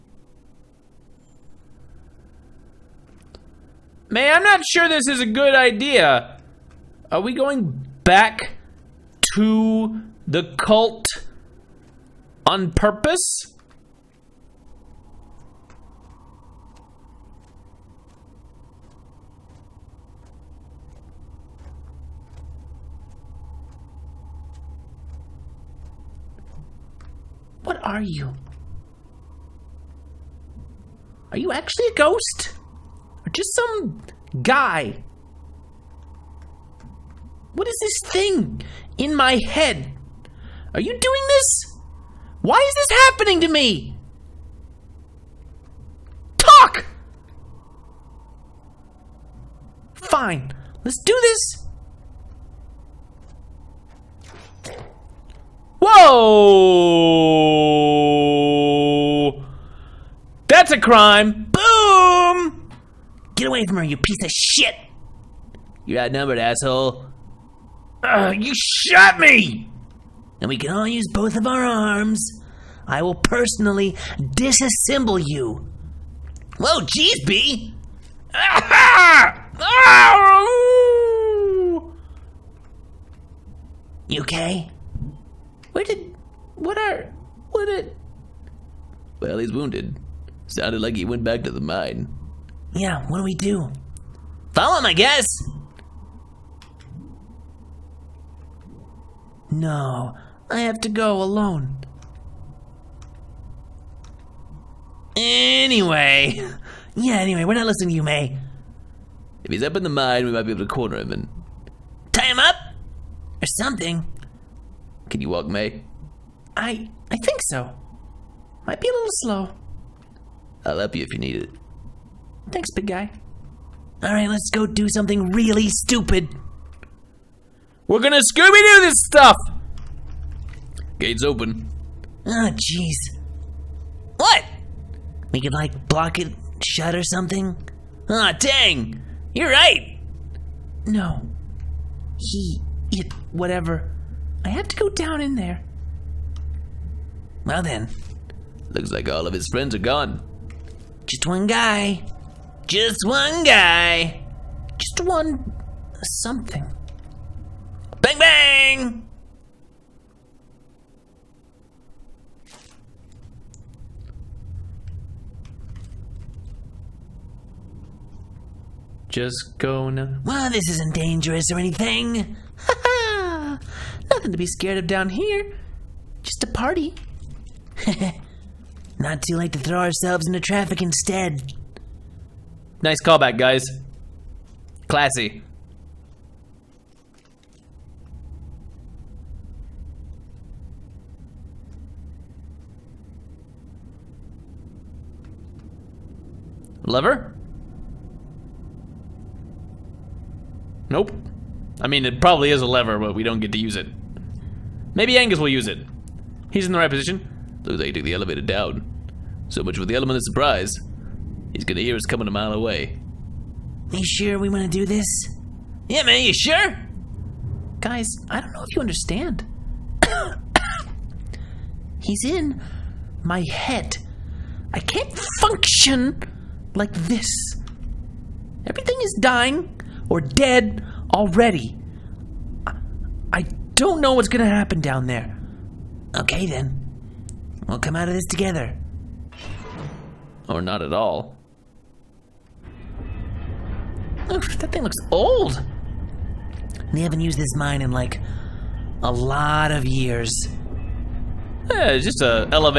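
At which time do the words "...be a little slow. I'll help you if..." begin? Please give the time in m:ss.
1:58.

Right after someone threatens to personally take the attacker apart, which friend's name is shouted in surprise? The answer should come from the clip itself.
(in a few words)
Bea.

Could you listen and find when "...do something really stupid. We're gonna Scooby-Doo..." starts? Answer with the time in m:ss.
2:04.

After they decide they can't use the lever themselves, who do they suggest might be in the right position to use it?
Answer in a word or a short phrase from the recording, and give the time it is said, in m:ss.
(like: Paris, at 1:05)
Angus, at 3:25.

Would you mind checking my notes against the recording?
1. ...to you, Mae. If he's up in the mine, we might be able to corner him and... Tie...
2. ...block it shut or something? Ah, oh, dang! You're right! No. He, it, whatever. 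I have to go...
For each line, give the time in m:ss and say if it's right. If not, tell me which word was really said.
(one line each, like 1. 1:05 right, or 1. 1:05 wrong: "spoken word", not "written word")
1. 1:47 right
2. 2:15 right.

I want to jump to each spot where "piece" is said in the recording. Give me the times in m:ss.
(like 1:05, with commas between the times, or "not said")
1:03.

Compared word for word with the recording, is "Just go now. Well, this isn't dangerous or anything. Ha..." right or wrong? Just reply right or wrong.
right.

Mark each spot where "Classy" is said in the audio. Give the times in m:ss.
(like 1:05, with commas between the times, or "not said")
3:04.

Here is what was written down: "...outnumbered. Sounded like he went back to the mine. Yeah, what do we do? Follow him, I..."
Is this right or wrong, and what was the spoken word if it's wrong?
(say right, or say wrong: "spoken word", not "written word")
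wrong: "wounded", not "outnumbered".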